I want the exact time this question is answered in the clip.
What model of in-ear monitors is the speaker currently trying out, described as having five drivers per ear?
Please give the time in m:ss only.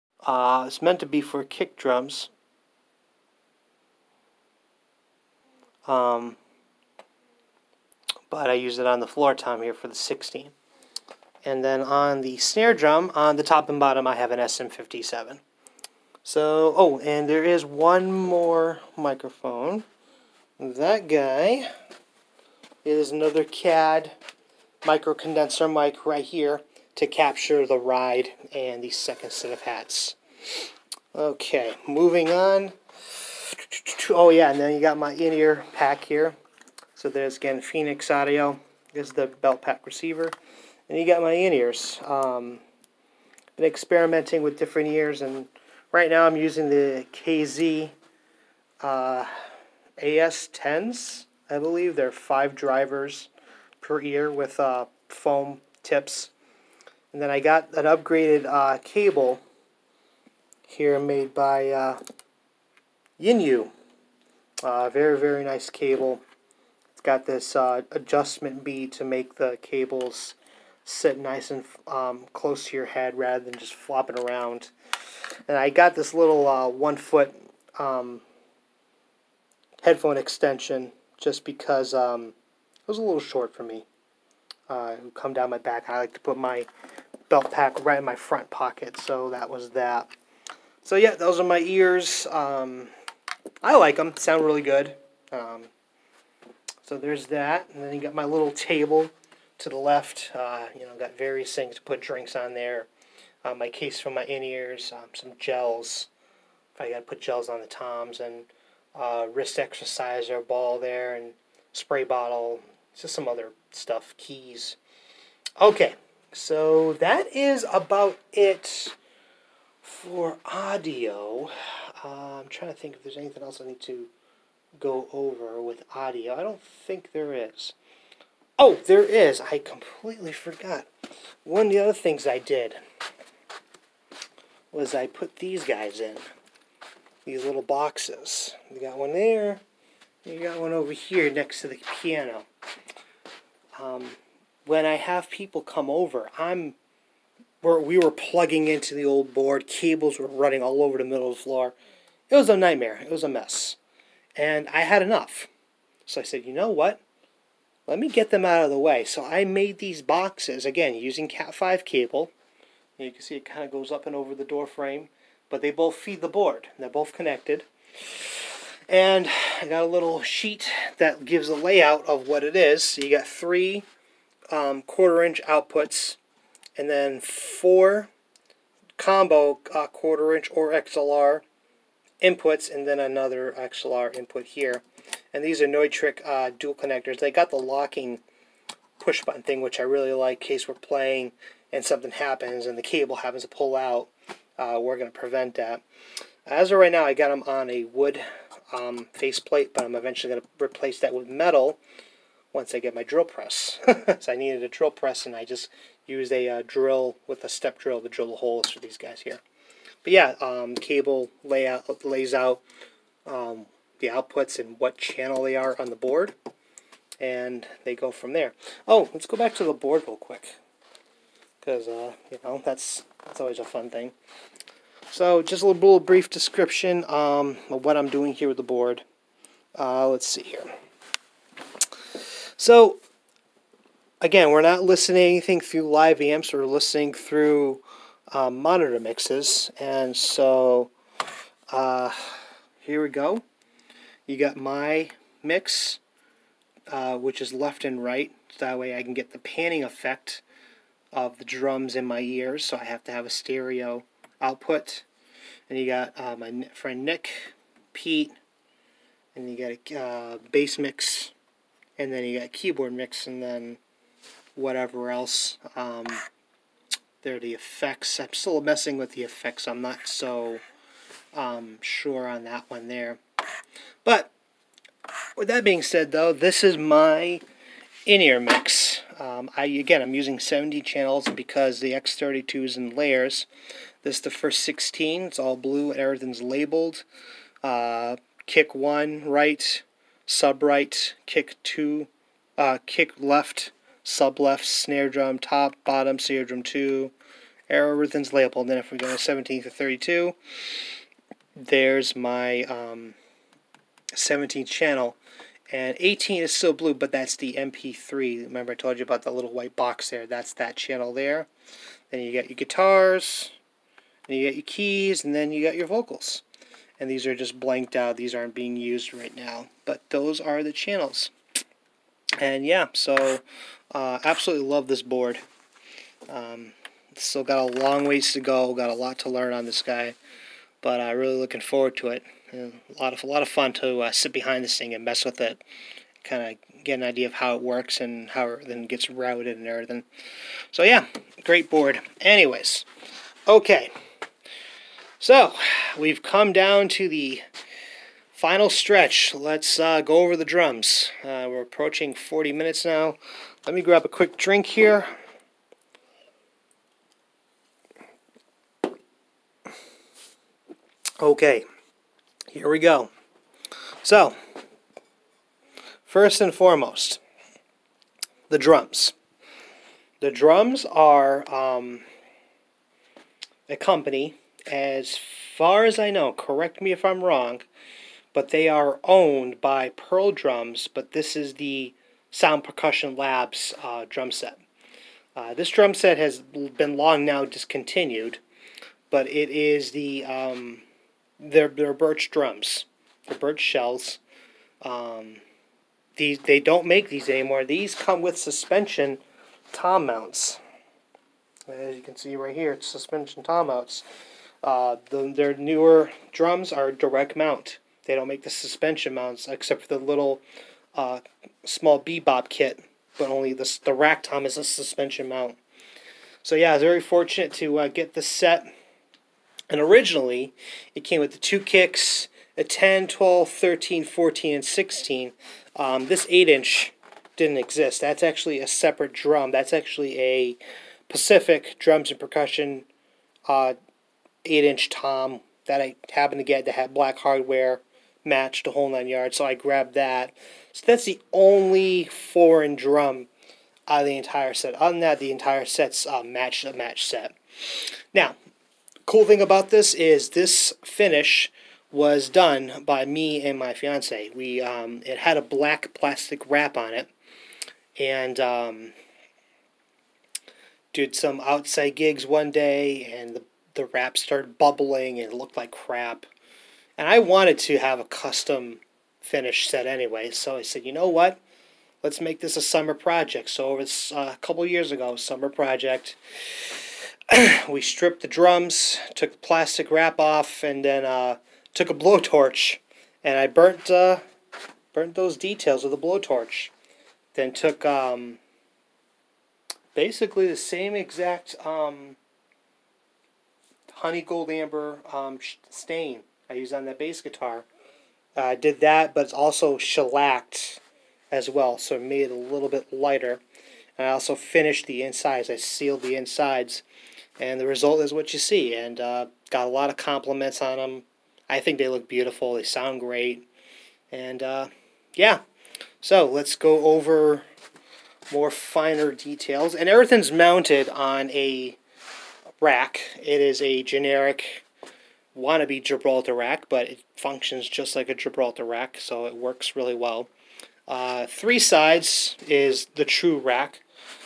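0:47.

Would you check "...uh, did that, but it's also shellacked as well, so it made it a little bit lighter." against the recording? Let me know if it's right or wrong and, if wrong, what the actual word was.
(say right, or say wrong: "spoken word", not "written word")
right.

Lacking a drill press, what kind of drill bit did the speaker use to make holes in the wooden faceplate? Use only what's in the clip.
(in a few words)
Step drill.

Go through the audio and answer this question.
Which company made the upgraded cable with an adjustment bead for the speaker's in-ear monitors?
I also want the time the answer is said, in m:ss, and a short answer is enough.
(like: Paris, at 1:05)
Yinyoo, at 1:03.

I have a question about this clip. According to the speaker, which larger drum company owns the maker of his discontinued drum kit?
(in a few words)
Pearl Drums.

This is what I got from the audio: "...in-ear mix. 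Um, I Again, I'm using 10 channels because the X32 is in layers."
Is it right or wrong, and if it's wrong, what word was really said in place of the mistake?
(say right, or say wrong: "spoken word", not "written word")
wrong: "70", not "10".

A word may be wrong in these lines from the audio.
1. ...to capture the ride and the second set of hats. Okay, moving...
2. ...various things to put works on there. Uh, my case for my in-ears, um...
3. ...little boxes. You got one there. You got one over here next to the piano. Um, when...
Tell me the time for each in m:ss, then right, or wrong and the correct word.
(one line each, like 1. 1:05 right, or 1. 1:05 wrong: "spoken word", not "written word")
1. 0:26 right
2. 1:41 wrong: "drinks", not "works"
3. 2:17 right.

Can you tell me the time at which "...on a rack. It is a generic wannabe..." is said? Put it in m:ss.
8:40.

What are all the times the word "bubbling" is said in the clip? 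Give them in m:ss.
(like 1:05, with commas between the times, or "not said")
7:44.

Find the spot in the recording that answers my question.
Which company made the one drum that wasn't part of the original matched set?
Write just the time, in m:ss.
7:11.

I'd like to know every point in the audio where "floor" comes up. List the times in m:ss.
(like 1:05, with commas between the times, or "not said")
0:09, 2:31.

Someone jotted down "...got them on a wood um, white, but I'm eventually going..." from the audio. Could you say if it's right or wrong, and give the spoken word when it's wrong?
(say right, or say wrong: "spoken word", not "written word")
wrong: "faceplate", not "white".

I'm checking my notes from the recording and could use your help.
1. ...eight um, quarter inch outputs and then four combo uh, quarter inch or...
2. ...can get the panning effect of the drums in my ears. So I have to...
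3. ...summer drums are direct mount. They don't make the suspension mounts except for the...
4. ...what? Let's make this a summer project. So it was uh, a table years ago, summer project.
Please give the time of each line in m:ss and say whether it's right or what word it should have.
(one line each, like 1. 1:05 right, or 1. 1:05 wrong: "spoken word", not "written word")
1. 2:53 wrong: "three", not "eight"
2. 4:09 right
3. 6:45 wrong: "newer", not "summer"
4. 7:51 wrong: "couple", not "table".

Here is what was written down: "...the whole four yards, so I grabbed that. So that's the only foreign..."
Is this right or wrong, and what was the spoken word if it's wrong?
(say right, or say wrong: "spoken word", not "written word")
wrong: "nine", not "four".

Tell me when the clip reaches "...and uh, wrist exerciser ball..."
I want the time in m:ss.
1:48.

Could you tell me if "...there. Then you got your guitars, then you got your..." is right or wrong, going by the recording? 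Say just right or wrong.
right.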